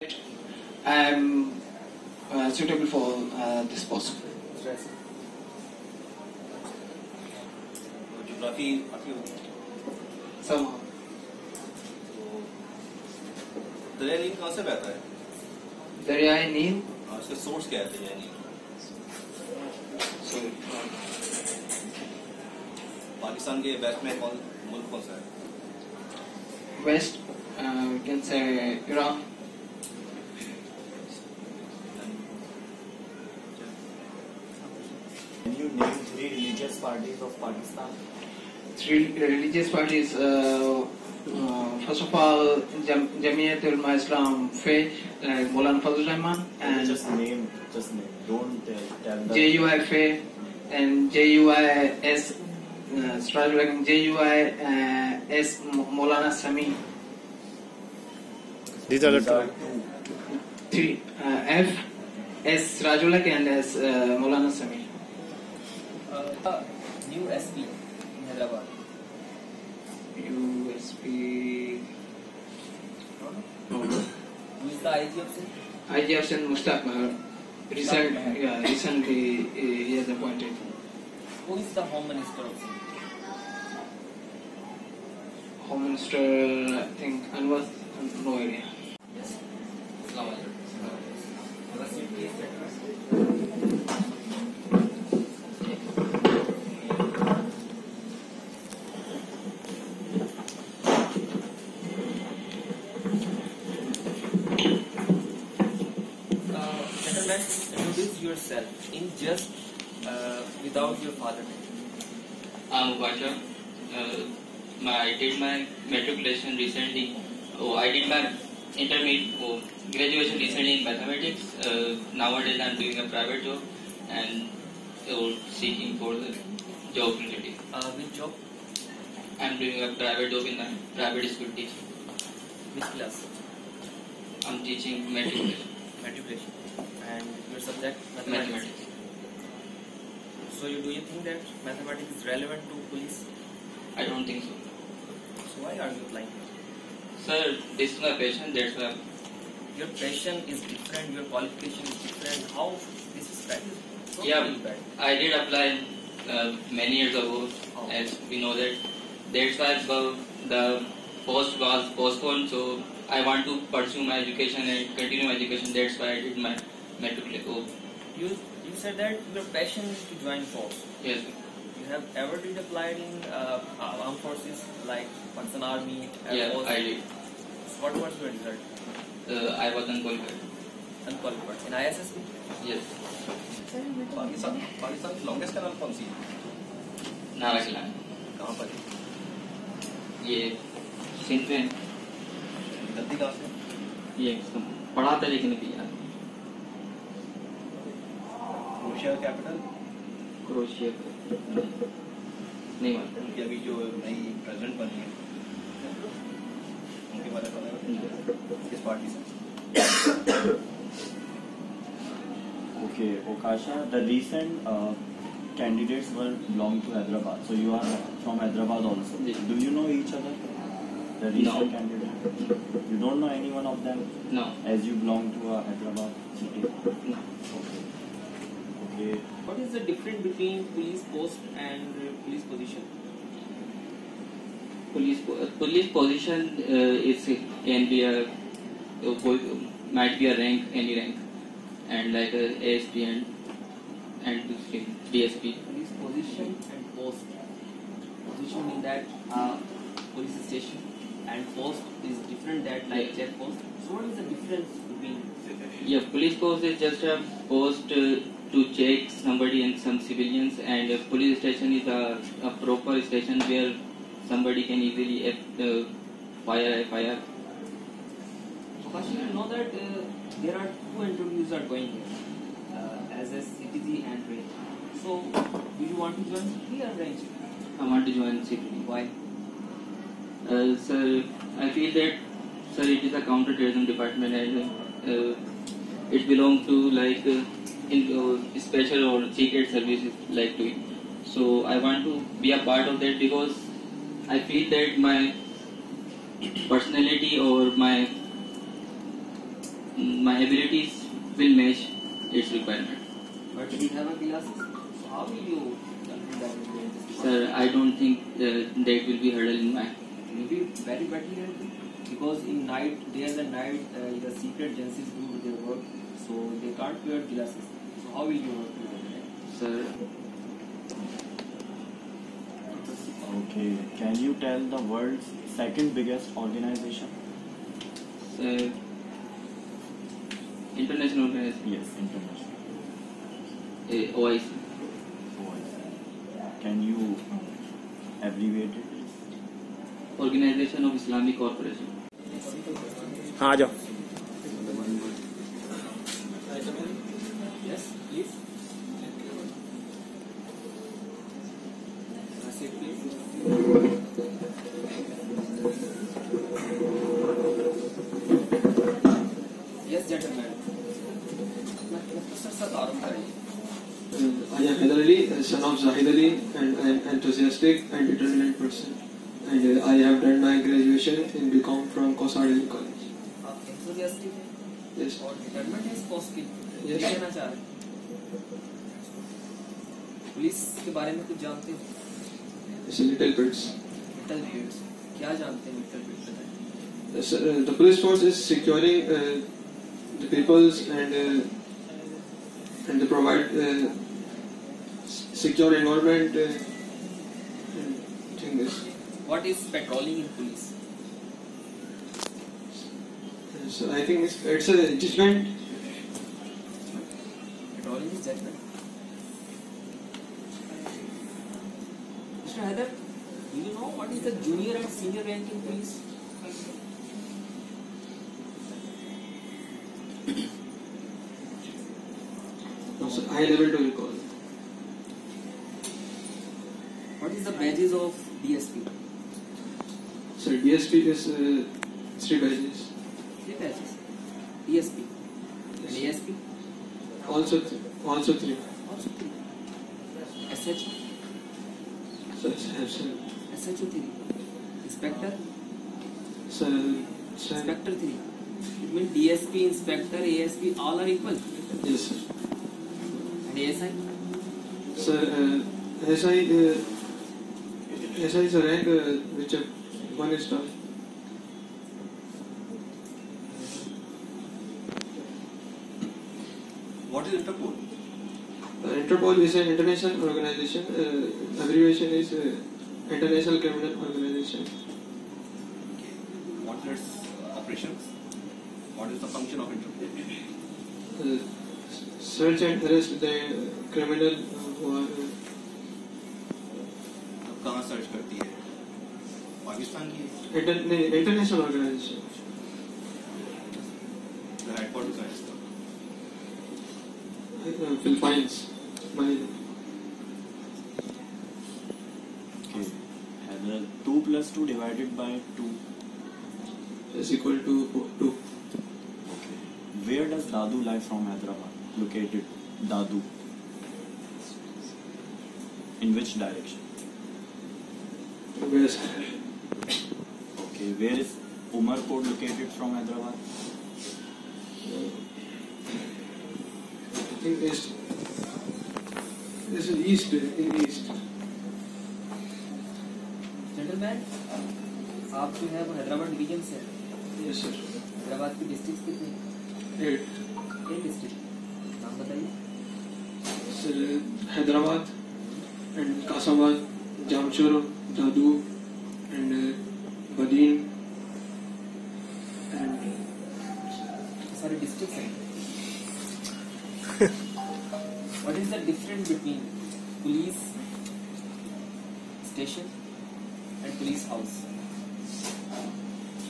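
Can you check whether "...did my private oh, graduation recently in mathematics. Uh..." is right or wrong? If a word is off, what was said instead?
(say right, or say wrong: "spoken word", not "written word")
wrong: "intermediate", not "private".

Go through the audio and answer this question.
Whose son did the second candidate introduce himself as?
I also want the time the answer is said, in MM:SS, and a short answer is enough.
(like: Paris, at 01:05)
Zahid Ali, at 06:05.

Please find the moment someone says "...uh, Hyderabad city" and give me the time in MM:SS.
03:45.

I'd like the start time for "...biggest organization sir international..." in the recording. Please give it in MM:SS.
05:25.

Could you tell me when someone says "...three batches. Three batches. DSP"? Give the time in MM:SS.
07:12.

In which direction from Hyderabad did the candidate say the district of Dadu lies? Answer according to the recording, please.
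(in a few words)
West.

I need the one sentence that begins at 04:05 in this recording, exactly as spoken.
Police position and post position in that uh, police station and post is different that like check post.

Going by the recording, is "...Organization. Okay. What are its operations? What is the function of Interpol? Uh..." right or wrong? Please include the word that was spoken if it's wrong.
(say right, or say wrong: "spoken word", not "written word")
right.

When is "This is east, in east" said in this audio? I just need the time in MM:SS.
08:49.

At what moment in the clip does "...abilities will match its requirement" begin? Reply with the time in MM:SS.
05:00.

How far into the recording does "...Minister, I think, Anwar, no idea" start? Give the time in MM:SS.
01:25.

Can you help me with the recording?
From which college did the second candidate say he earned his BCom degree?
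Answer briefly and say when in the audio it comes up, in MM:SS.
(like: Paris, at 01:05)
Kosar College, at 06:12.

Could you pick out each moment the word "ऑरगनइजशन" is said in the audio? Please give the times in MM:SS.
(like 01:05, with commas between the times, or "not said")
05:40, 08:11.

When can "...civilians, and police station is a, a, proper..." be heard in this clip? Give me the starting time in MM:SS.
04:19.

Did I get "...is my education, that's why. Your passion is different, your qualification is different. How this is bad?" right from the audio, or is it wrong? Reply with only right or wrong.
wrong.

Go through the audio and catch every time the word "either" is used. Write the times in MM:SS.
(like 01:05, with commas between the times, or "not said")
not said.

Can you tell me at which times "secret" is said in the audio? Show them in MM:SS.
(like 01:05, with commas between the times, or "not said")
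04:49, 05:14.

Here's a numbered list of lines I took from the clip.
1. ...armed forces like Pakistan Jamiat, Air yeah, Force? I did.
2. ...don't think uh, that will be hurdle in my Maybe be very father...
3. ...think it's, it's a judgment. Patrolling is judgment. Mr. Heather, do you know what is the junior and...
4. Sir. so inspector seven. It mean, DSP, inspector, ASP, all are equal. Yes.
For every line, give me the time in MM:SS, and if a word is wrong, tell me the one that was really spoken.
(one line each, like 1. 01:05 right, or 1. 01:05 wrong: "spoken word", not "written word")
1. 02:54 wrong: "Army", not "Jamiat"
2. 05:07 wrong: "better", not "father"
3. 06:44 right
4. 07:26 wrong: "three", not "seven".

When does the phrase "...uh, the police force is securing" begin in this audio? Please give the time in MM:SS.
06:27.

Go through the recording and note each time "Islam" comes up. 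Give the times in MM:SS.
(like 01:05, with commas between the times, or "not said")
00:43.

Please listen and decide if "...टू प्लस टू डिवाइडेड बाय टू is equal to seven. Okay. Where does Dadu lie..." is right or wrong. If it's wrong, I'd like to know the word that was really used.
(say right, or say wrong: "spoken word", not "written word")
wrong: "two", not "seven".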